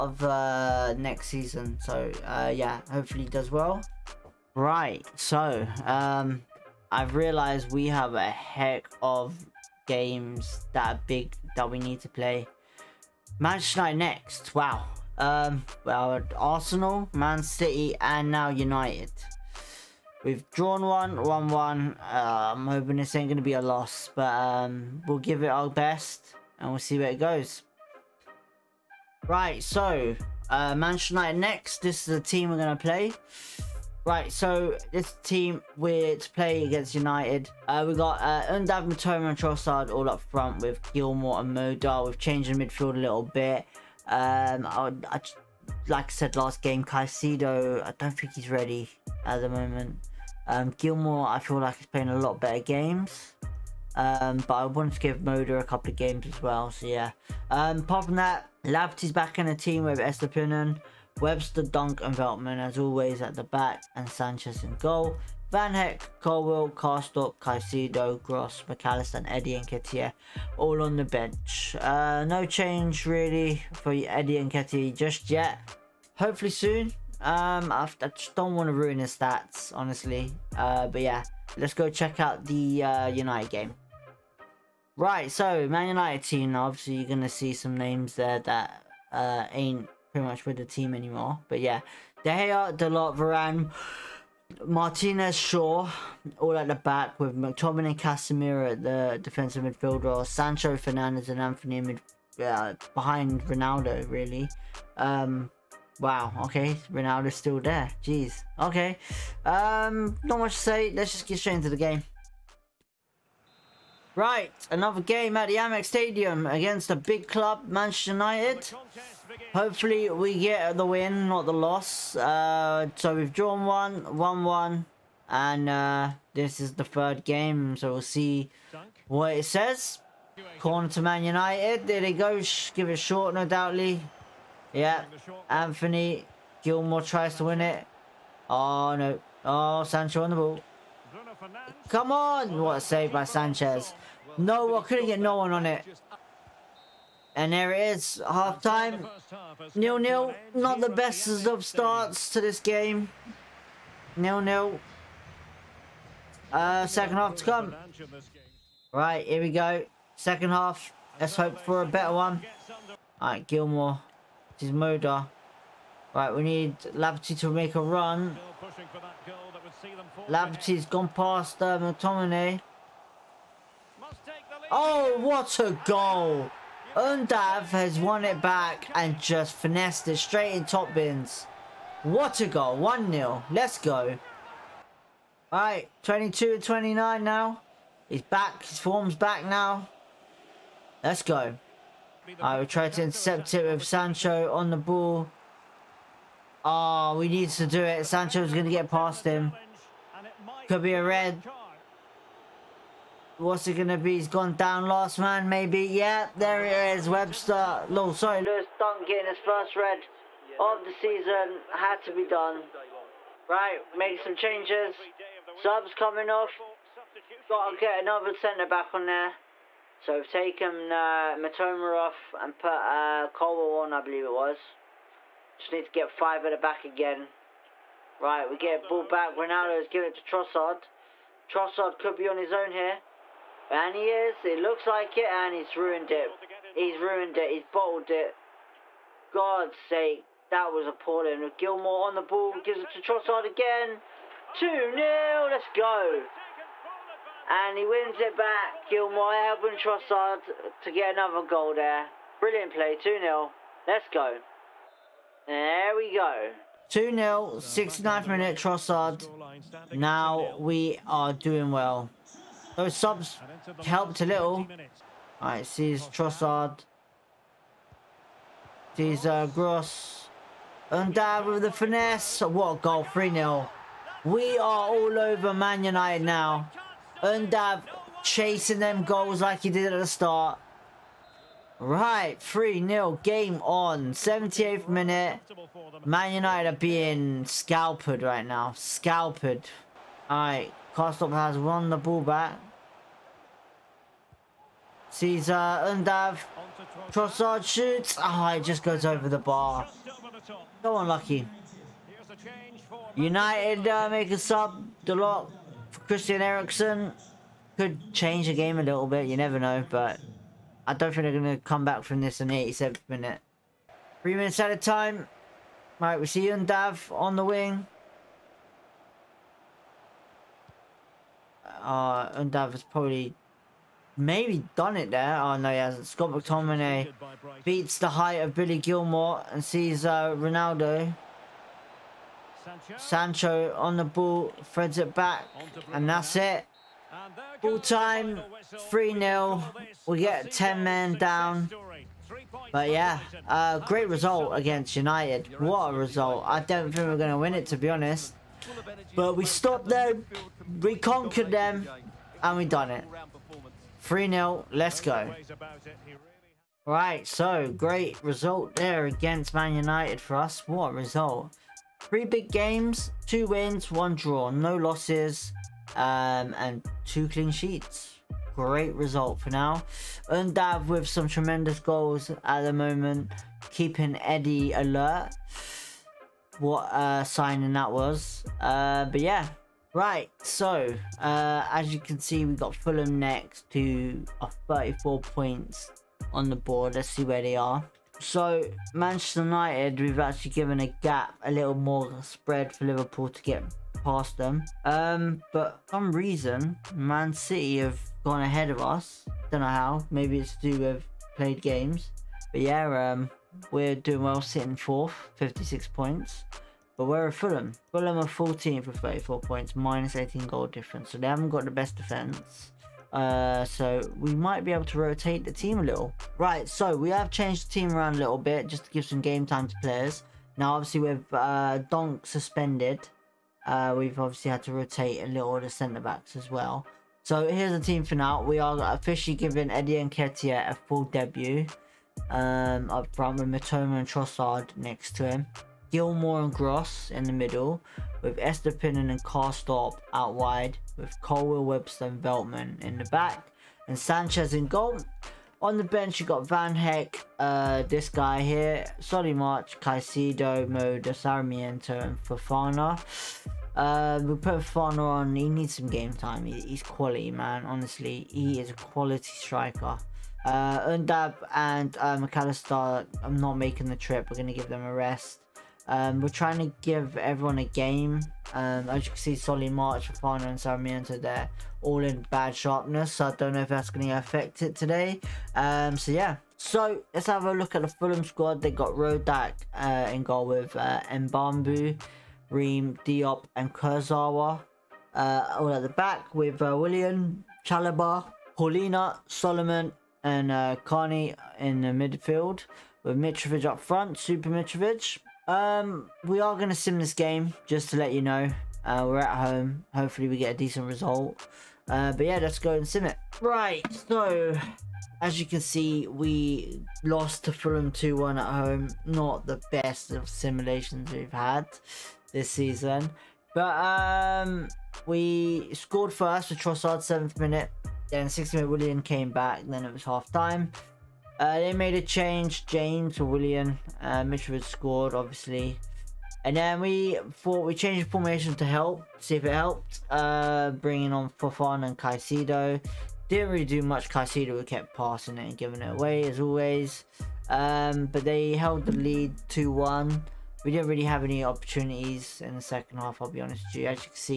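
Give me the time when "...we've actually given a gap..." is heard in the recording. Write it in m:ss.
6:30.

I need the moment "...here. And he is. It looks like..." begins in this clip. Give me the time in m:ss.
3:52.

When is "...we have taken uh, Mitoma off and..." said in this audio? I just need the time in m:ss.
3:40.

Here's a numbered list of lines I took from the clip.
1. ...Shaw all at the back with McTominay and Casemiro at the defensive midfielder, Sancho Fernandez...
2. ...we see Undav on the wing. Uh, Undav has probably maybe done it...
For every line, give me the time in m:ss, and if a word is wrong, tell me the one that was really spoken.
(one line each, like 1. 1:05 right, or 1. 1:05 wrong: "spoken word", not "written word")
1. 1:35 right
2. 5:16 right.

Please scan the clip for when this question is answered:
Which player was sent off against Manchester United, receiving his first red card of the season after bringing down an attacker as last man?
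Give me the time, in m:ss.
3:28.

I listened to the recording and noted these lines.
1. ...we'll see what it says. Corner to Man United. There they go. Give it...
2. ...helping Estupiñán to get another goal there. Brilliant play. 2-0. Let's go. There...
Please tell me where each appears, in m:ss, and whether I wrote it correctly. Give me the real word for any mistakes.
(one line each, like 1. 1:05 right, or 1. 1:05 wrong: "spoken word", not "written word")
1. 2:07 right
2. 4:09 wrong: "Trossard", not "Estupiñán".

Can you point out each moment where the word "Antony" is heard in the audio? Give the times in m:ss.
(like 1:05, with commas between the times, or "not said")
1:41, 2:15.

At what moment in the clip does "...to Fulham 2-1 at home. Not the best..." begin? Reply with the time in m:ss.
8:27.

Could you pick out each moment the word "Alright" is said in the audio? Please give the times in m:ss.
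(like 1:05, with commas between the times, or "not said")
2:43, 3:05, 4:25, 4:50.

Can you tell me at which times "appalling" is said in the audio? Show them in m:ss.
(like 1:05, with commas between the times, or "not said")
4:00.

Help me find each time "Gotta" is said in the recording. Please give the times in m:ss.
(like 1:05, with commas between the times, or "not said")
3:37.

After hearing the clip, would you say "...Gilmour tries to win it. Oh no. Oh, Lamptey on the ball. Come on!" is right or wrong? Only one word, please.
wrong.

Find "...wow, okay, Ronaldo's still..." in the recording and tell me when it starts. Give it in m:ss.
1:45.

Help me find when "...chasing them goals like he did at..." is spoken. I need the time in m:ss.
4:38.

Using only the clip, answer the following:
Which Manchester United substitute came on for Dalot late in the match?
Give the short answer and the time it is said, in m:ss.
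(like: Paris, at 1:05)
Christian Eriksen, at 5:06.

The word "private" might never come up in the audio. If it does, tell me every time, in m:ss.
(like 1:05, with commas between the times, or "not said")
not said.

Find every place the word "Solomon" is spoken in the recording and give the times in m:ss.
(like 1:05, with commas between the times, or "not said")
8:09.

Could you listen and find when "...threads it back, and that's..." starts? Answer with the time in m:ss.
5:34.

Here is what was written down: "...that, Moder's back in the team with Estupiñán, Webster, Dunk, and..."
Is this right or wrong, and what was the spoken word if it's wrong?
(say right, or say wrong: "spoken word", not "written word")
wrong: "Lamptey", not "Moder".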